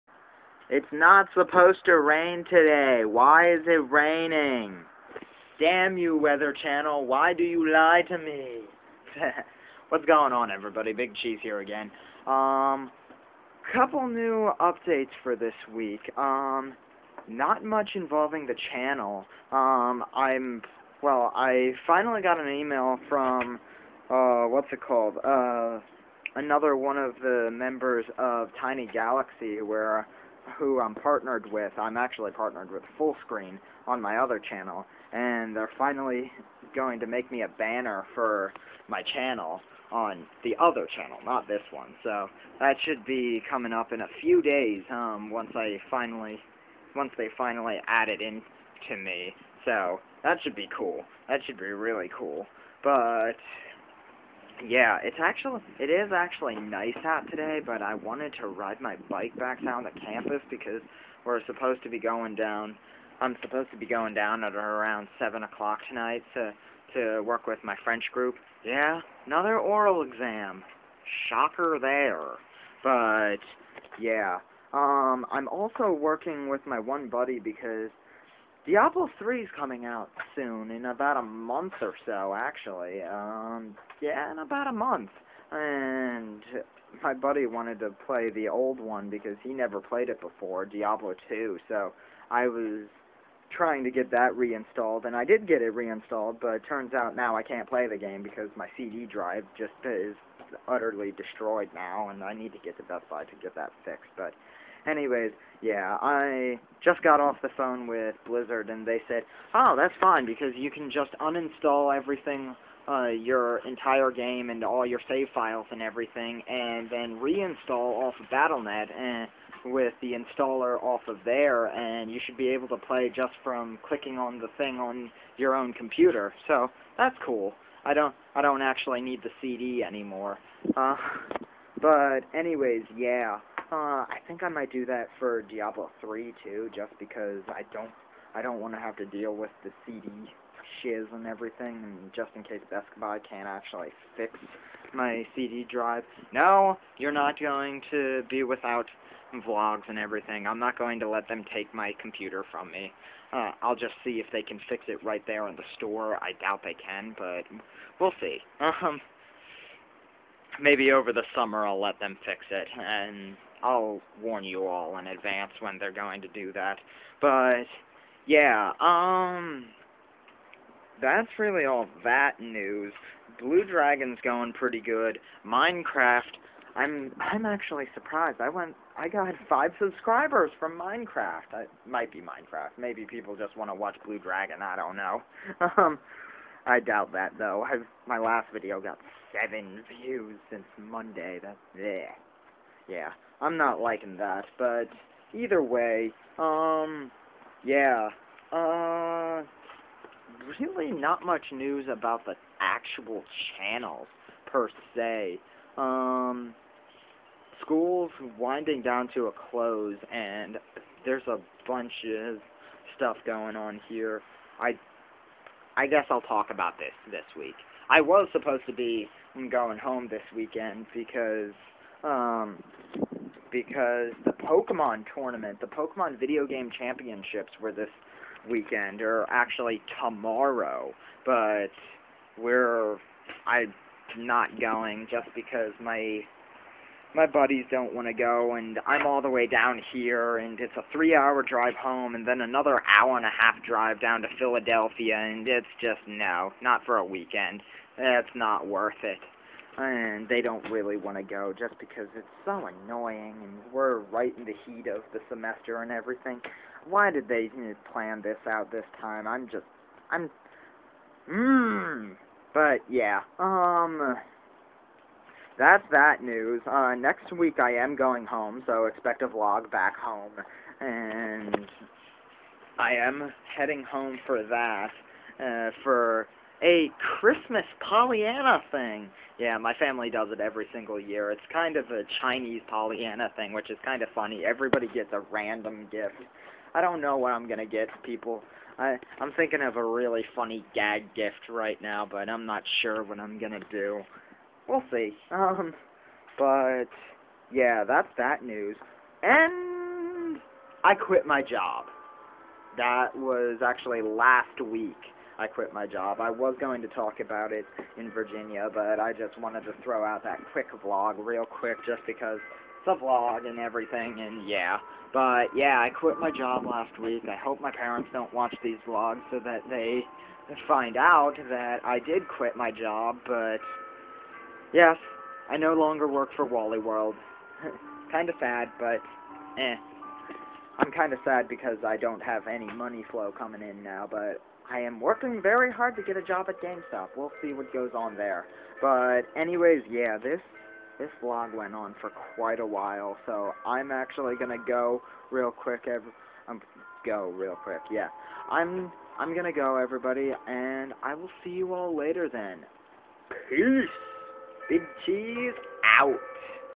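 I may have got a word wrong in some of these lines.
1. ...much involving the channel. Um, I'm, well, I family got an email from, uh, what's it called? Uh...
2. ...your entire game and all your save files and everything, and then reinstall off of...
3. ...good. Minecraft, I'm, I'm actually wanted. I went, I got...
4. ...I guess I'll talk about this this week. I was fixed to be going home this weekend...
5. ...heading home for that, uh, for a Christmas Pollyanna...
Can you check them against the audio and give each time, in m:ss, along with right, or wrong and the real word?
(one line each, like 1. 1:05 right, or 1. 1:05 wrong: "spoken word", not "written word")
1. 0:17 wrong: "finally", not "family"
2. 1:53 right
3. 2:54 wrong: "surprised", not "wanted"
4. 3:35 wrong: "supposed", not "fixed"
5. 4:33 right.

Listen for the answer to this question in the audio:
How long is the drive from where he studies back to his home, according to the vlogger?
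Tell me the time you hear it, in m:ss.
4:00.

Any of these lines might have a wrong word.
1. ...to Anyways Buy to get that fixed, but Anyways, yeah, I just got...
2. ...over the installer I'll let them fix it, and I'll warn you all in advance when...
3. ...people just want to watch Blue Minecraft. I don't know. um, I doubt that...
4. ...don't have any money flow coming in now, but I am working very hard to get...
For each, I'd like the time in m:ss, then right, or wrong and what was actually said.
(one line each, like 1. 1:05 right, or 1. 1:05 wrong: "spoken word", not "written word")
1. 1:42 wrong: "Best", not "Anyways"
2. 2:40 wrong: "summer", not "installer"
3. 3:03 wrong: "Dragon", not "Minecraft"
4. 5:31 right.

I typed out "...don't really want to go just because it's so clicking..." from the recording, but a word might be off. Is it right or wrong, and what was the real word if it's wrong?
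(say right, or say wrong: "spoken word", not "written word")
wrong: "annoying", not "clicking".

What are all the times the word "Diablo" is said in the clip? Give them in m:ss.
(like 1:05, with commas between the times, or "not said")
1:18, 1:30, 2:15.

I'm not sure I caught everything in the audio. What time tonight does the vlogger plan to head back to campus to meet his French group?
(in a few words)
7 o'clock.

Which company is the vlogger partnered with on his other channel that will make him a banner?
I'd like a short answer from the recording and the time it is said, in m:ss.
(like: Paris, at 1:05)
Full Screen, at 0:32.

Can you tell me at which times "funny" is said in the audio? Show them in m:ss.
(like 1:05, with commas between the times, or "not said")
4:44, 4:50.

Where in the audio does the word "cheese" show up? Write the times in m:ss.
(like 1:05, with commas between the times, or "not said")
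0:11, 5:55.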